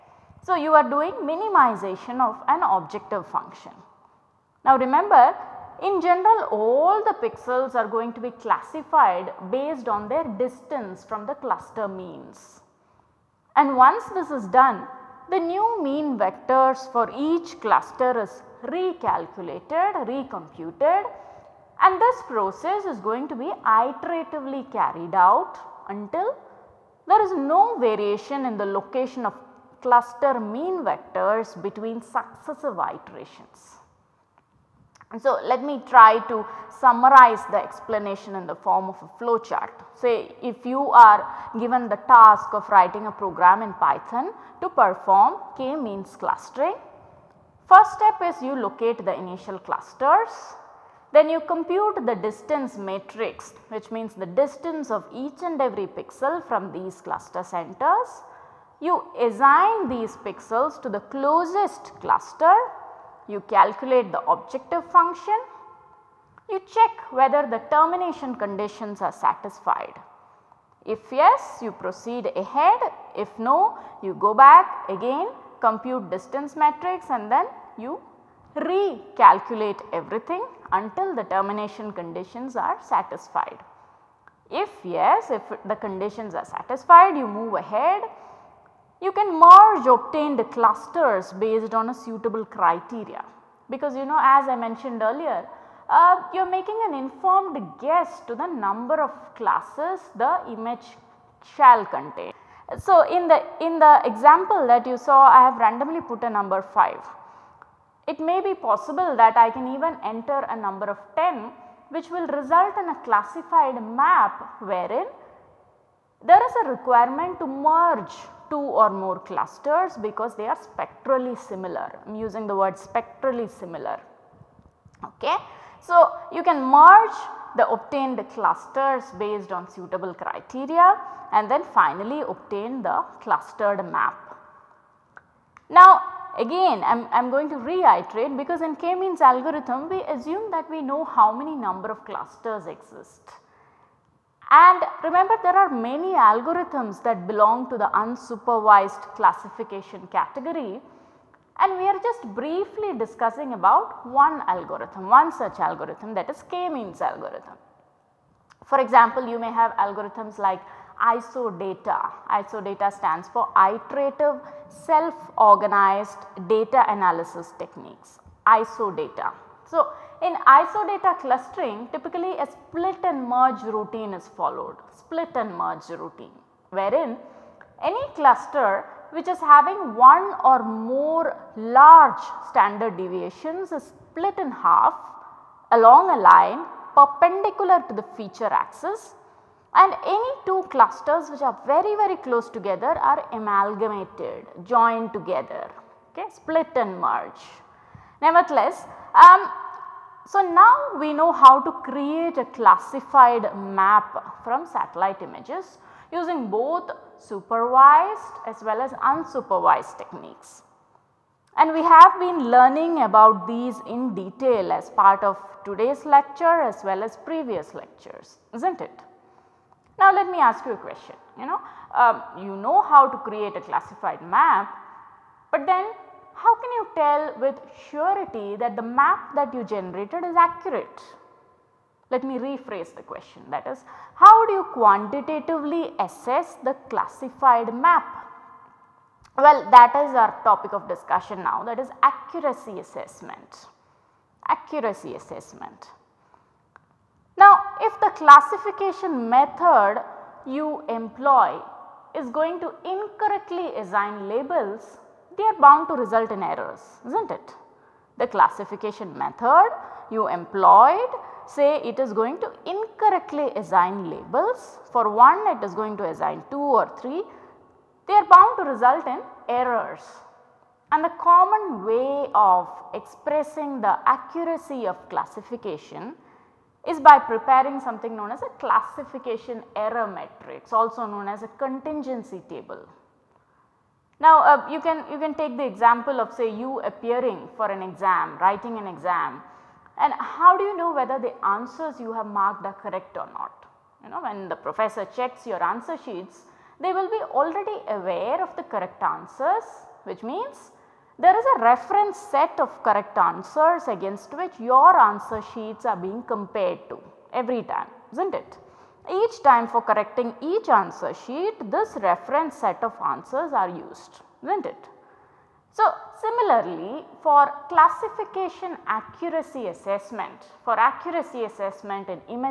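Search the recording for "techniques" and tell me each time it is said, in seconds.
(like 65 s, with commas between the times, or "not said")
167 s, 209 s.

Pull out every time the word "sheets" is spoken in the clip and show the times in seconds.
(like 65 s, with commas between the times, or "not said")
296 s, 305 s, 311 s.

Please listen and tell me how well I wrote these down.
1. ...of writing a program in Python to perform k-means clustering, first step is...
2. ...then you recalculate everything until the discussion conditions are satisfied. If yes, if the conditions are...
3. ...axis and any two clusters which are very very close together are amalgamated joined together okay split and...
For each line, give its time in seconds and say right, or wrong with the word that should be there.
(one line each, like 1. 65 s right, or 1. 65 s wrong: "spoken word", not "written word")
1. 42 s right
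2. 77 s wrong: "termination", not "discussion"
3. 188 s right.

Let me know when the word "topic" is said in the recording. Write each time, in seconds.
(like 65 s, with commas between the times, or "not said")
240 s.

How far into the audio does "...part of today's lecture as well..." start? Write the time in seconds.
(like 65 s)
214 s.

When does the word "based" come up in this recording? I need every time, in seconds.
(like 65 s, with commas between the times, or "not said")
9 s, 91 s, 129 s.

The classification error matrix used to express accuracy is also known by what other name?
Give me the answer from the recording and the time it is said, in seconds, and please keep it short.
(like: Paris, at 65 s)
contingency table, at 281 s.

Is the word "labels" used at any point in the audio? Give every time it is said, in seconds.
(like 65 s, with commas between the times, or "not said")
254 s, 264 s.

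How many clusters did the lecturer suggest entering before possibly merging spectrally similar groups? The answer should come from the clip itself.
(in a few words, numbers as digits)
10.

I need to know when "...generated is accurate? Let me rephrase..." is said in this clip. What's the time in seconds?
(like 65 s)
229 s.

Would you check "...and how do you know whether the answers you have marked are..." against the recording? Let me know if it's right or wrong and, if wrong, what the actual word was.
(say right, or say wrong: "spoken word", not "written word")
right.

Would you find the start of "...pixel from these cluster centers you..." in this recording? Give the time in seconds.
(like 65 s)
55 s.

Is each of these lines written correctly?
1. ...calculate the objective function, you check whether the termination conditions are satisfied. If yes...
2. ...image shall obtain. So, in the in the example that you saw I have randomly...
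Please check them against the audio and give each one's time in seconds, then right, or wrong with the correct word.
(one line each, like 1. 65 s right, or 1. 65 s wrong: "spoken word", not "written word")
1. 63 s right
2. 100 s wrong: "contain", not "obtain".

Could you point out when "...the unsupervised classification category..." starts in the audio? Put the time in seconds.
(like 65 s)
147 s.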